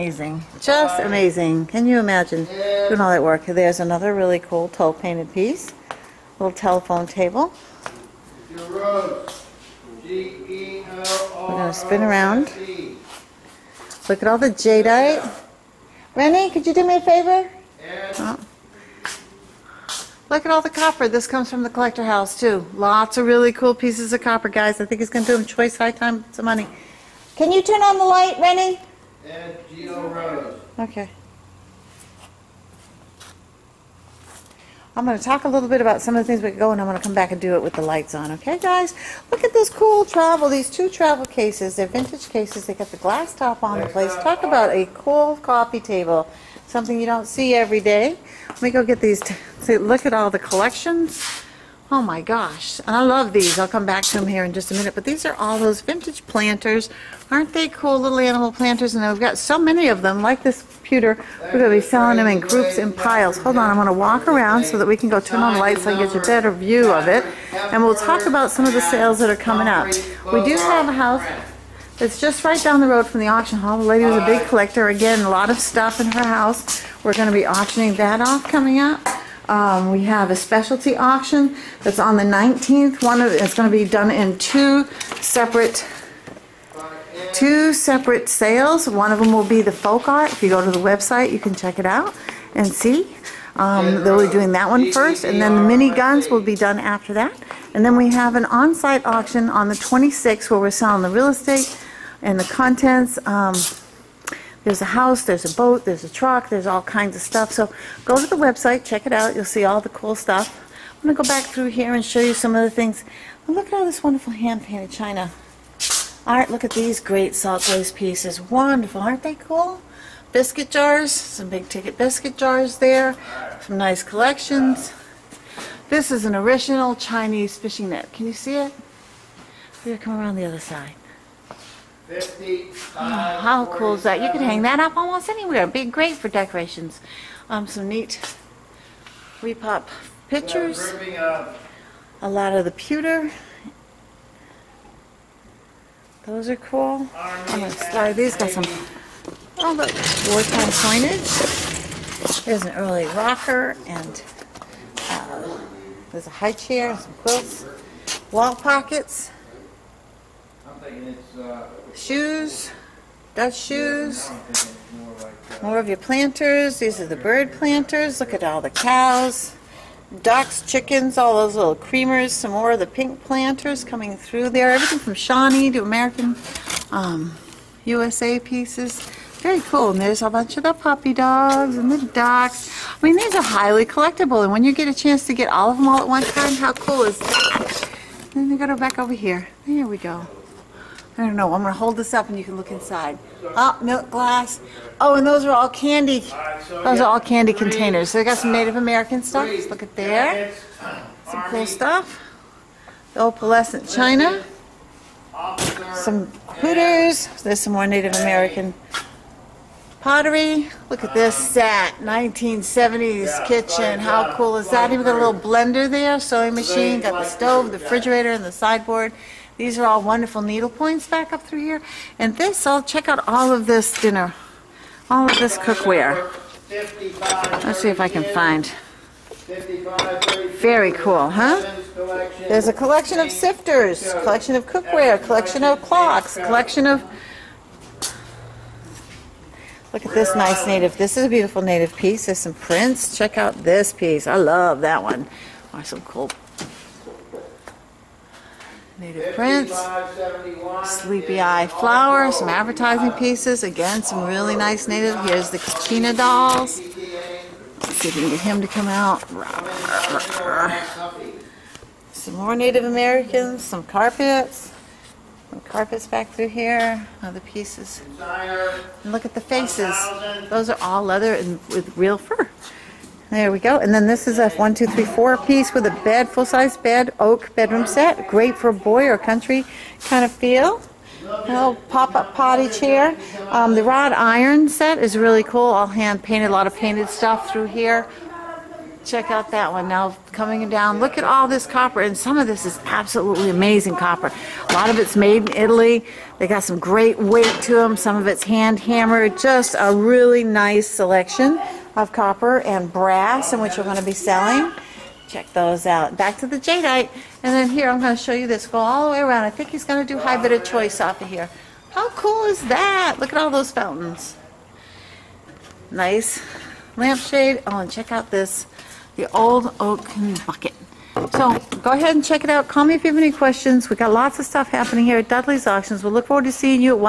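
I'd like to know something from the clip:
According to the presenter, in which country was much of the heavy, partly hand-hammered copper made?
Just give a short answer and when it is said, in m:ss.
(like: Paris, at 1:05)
Italy, at 4:55.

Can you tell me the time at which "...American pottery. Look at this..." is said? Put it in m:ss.
3:28.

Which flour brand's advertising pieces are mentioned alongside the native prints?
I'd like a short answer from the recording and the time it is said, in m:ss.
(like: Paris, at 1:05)
Sleepy Eye, at 4:10.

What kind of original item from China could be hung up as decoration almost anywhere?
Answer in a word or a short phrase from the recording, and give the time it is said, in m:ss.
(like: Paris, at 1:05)
Fishing net, at 2:06.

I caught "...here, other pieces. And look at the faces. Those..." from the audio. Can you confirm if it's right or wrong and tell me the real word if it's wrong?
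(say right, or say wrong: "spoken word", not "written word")
right.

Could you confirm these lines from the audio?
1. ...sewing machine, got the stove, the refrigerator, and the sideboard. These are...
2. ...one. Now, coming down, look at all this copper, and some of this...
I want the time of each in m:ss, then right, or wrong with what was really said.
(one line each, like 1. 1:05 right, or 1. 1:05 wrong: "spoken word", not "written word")
1. 3:36 right
2. 4:49 right.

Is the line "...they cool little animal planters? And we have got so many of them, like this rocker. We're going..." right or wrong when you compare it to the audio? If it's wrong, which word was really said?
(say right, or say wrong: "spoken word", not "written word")
wrong: "pewter", not "rocker".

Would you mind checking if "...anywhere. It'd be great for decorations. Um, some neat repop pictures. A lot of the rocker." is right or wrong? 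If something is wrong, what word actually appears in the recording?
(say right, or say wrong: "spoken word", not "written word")
wrong: "pewter", not "rocker".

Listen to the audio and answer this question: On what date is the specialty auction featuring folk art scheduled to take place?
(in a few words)
19th.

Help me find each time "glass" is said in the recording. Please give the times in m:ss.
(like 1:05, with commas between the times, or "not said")
0:42, 3:14.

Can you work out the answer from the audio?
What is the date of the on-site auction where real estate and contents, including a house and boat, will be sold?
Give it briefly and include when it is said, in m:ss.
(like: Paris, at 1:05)
26th, at 1:39.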